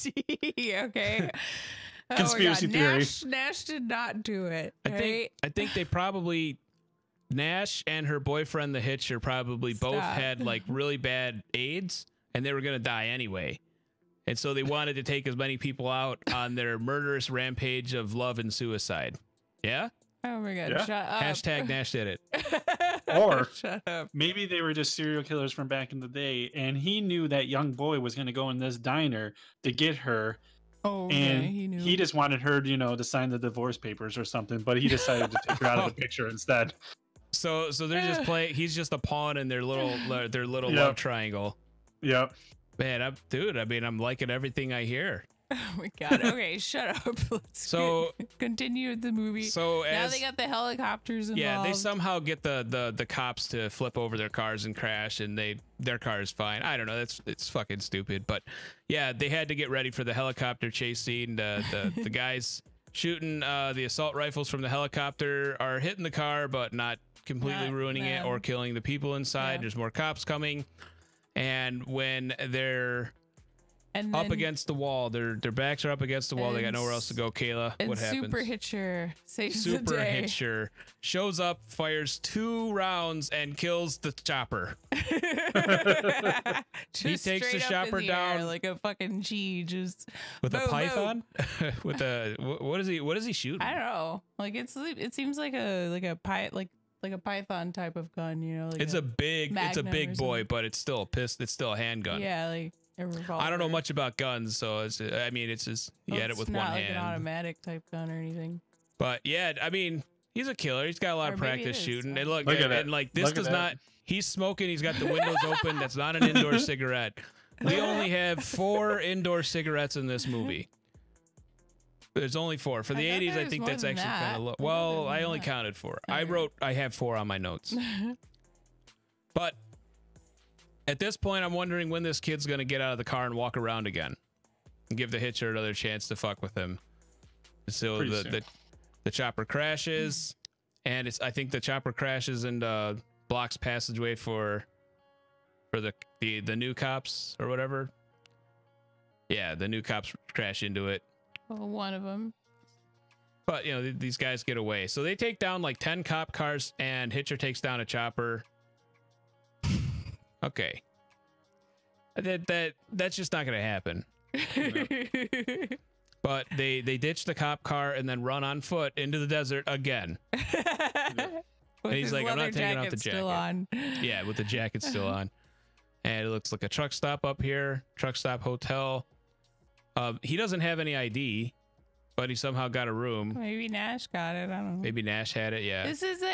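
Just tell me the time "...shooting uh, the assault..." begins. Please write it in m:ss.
1:02.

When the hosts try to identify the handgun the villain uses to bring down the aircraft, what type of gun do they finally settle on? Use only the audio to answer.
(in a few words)
revolver.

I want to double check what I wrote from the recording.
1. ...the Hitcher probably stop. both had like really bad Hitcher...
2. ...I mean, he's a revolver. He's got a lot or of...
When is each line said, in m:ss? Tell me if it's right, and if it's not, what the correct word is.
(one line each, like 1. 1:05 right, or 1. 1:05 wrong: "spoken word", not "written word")
1. 0:08 wrong: "AIDS", not "Hitcher"
2. 1:49 wrong: "killer", not "revolver".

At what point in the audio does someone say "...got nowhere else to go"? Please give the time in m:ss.
1:16.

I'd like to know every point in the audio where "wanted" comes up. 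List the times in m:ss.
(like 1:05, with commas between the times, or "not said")
0:14, 0:32.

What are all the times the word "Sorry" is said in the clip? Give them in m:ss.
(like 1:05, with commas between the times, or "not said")
2:06.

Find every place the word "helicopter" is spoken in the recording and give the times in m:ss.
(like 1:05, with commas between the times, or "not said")
0:50, 1:00, 1:04.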